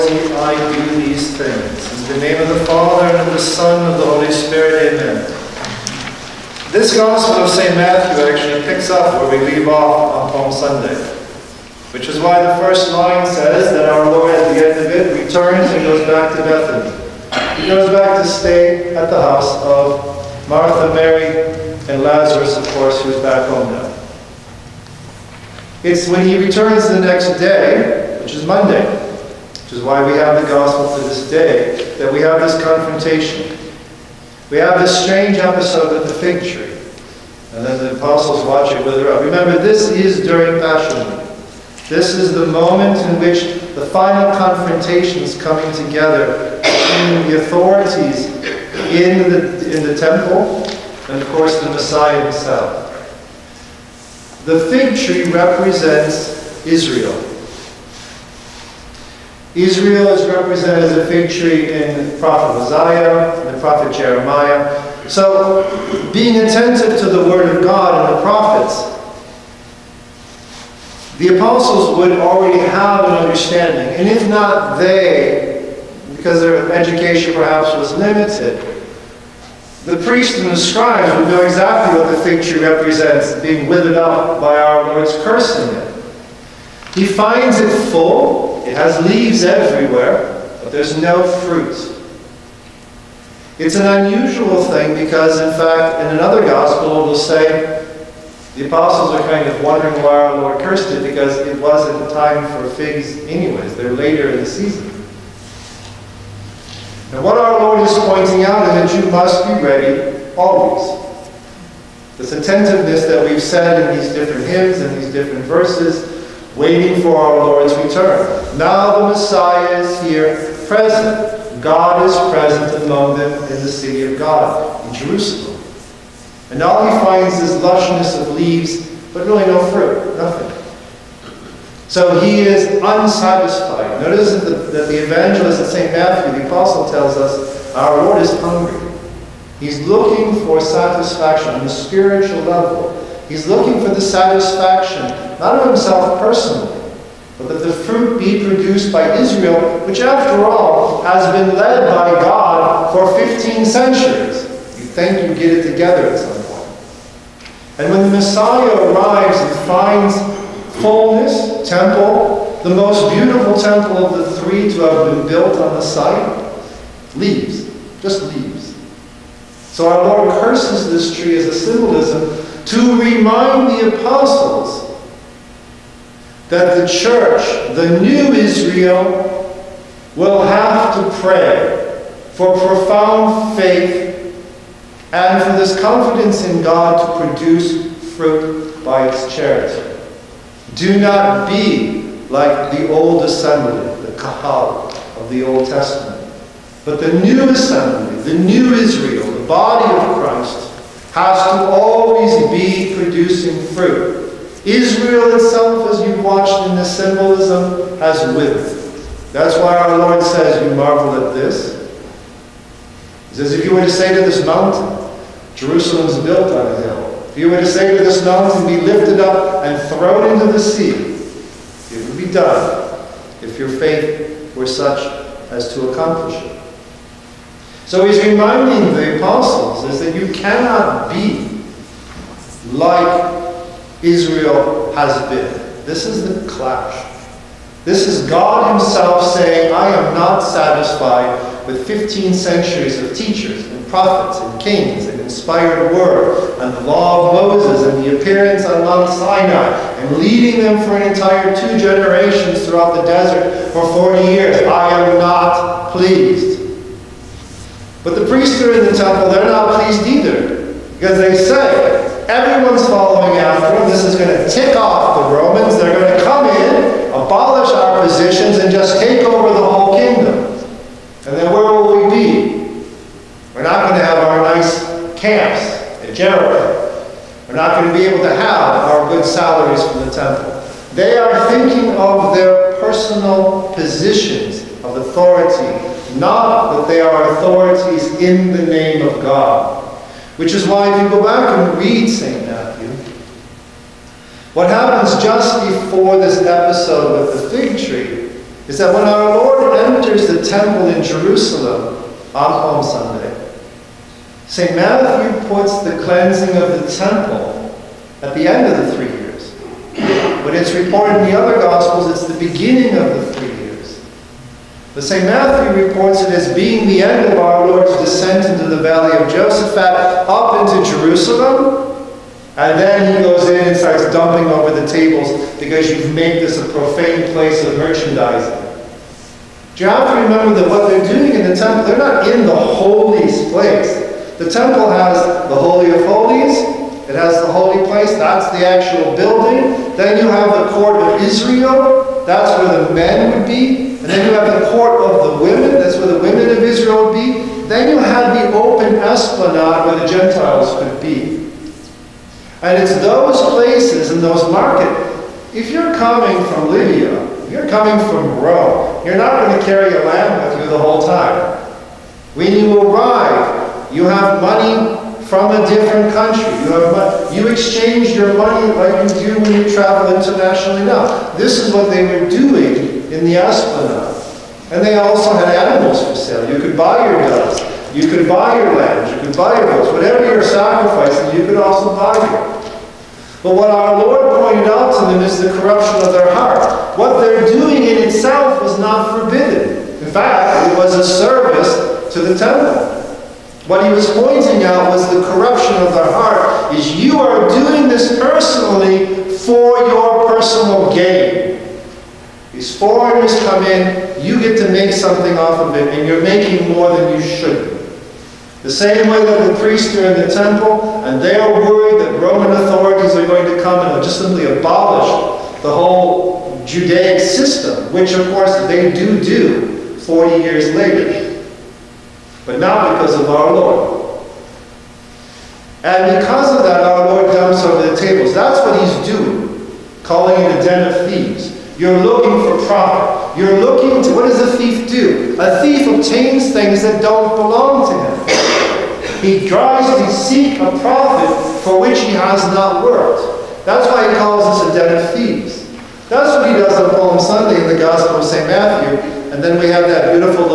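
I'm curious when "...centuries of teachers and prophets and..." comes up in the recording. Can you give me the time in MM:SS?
04:02.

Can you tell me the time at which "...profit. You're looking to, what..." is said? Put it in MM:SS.
07:12.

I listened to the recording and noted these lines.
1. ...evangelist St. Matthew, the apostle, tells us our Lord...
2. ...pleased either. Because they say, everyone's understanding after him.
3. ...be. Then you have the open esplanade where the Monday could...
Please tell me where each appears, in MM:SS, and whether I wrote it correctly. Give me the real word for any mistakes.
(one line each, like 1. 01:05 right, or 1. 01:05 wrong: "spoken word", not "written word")
1. 02:15 right
2. 04:19 wrong: "following", not "understanding"
3. 05:47 wrong: "Gentiles", not "Monday".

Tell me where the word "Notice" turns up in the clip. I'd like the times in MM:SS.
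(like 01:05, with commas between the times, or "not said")
02:14.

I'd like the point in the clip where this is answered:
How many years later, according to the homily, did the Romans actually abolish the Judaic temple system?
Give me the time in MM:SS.
06:59.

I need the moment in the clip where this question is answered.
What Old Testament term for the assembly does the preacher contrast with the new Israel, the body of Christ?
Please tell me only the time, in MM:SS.
03:14.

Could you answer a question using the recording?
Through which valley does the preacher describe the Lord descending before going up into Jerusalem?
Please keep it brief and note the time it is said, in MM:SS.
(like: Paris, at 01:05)
Valley of Josaphat, at 05:18.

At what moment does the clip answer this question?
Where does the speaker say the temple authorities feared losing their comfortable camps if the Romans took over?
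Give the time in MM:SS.
04:36.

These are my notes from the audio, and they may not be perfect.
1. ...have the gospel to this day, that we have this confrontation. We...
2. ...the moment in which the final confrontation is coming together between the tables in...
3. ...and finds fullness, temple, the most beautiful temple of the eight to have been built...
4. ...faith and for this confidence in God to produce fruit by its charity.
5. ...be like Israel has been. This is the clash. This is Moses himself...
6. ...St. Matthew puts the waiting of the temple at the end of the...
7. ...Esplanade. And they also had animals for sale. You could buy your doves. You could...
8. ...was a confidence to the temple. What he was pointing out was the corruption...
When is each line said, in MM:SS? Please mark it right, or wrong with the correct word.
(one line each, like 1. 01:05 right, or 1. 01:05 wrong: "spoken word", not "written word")
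1. 00:30 right
2. 00:42 wrong: "authorities", not "tables"
3. 02:39 wrong: "three", not "eight"
4. 03:03 right
5. 03:51 wrong: "God", not "Moses"
6. 05:04 wrong: "cleansing", not "waiting"
7. 06:13 right
8. 06:30 wrong: "service", not "confidence".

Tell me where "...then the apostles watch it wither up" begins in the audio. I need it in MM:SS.
00:37.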